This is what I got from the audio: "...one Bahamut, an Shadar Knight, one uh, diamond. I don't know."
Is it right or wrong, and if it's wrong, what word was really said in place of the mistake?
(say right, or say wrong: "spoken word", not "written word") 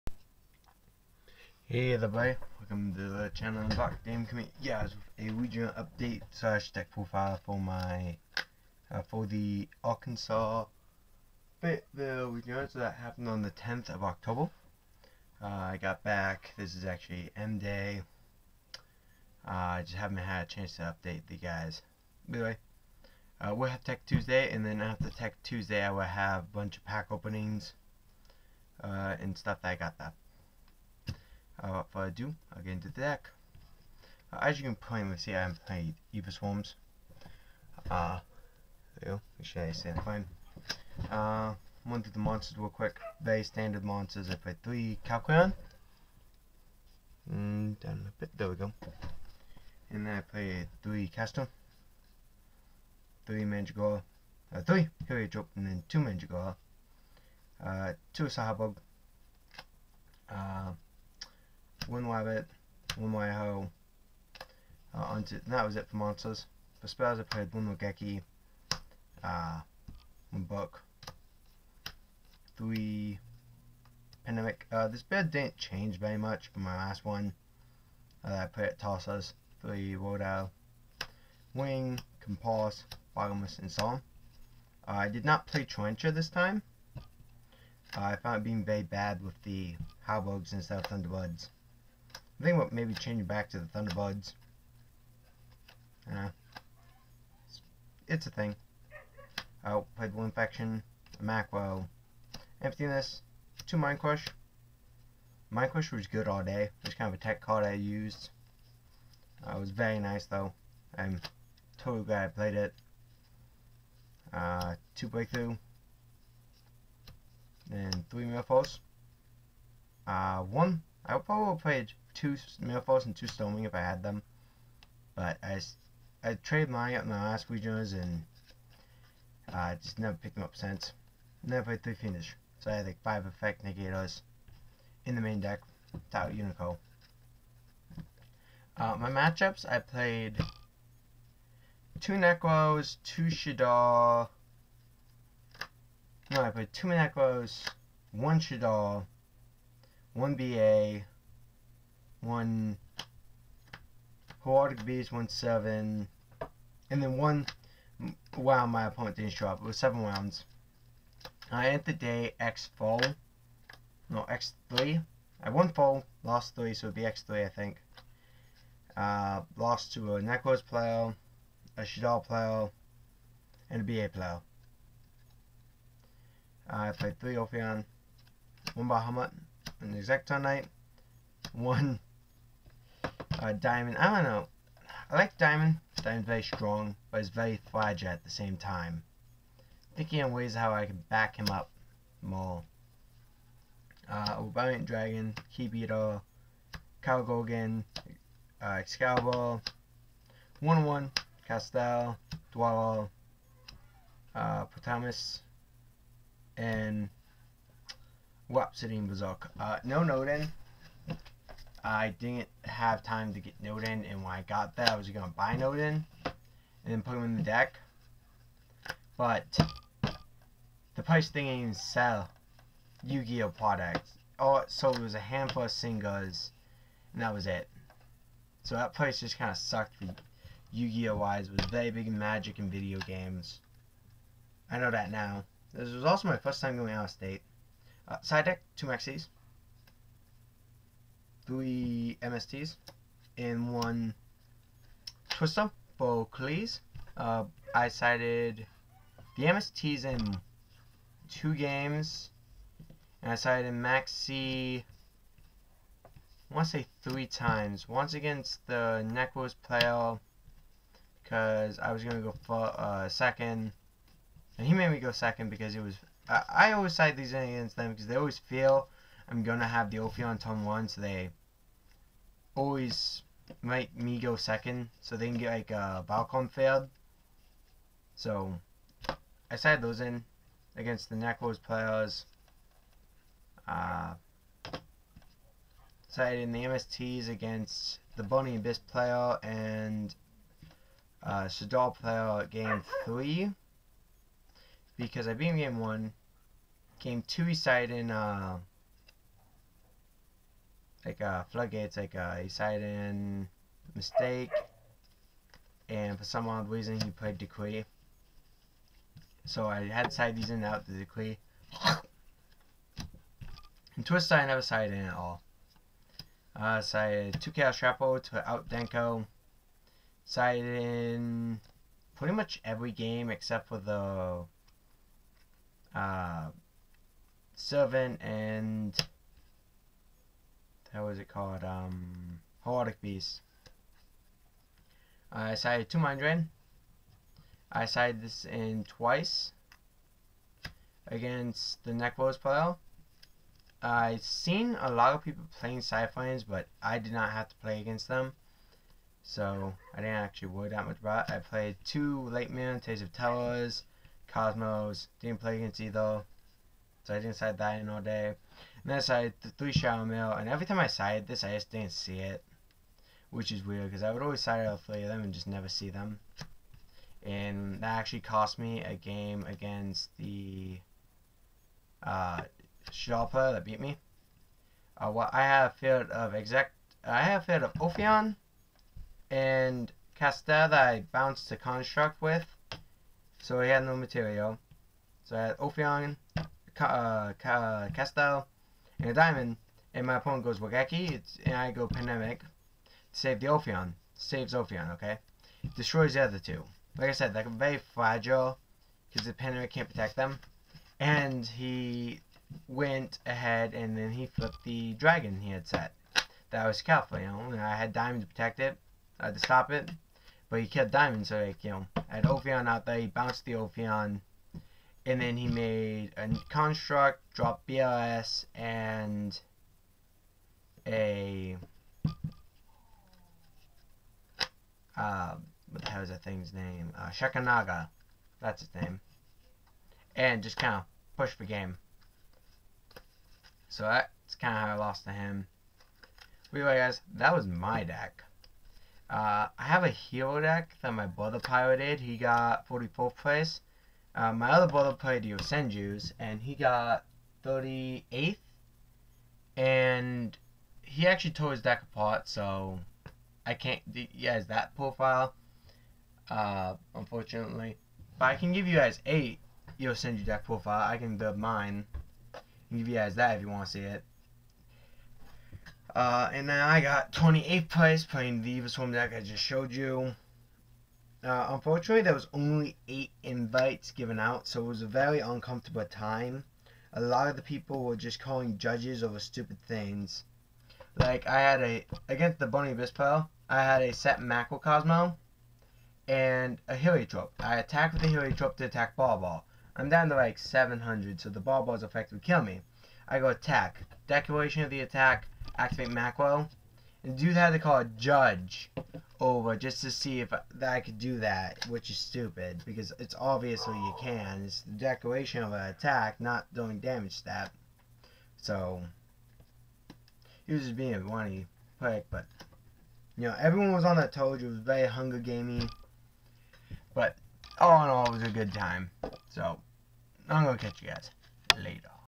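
wrong: "Exciton", not "Shadar".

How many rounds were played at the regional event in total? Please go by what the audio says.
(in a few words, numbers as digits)
7.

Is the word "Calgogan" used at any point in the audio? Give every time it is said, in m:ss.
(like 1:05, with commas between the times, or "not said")
3:17.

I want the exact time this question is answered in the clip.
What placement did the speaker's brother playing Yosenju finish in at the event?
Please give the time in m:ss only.
7:27.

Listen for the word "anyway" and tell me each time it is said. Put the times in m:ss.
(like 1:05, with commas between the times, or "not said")
0:22, 7:16.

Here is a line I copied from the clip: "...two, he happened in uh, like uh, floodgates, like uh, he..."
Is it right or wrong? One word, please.
wrong.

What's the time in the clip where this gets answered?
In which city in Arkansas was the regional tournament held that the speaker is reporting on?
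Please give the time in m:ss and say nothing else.
0:11.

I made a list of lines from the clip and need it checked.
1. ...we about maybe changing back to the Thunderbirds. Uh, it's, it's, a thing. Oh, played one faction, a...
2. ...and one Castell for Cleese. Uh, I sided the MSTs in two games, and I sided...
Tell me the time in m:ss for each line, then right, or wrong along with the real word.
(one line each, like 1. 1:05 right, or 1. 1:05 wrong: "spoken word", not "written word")
1. 1:32 right
2. 4:03 wrong: "Twister", not "Castell".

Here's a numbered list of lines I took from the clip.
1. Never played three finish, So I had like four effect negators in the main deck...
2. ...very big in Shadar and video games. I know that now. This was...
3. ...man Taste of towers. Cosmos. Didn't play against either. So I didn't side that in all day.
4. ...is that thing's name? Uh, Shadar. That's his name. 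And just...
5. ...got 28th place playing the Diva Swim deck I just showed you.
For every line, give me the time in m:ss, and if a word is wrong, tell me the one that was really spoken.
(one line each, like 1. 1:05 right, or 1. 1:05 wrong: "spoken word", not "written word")
1. 2:11 wrong: "five", not "four"
2. 3:51 wrong: "Magic", not "Shadar"
3. 5:52 right
4. 7:06 wrong: "Shekhinaga", not "Shadar"
5. 7:46 right.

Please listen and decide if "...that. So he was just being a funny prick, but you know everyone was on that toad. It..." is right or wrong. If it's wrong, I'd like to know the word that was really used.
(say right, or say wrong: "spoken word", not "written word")
right.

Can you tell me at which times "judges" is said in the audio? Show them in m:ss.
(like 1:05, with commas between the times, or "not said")
7:58, 8:17.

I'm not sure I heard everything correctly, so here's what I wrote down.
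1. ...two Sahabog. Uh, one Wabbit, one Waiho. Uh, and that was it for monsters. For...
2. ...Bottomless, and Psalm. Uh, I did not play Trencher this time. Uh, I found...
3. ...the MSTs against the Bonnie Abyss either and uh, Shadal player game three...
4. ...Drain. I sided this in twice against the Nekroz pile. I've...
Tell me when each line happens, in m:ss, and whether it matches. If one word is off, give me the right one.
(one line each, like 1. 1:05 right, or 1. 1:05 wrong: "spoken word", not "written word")
1. 0:58 right
2. 1:23 right
3. 4:46 wrong: "player", not "either"
4. 5:36 right.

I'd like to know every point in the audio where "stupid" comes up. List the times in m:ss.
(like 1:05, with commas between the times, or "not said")
7:59, 8:21.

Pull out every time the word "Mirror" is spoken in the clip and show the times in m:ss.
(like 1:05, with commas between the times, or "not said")
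1:58, 2:02.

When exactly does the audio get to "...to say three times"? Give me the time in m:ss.
4:16.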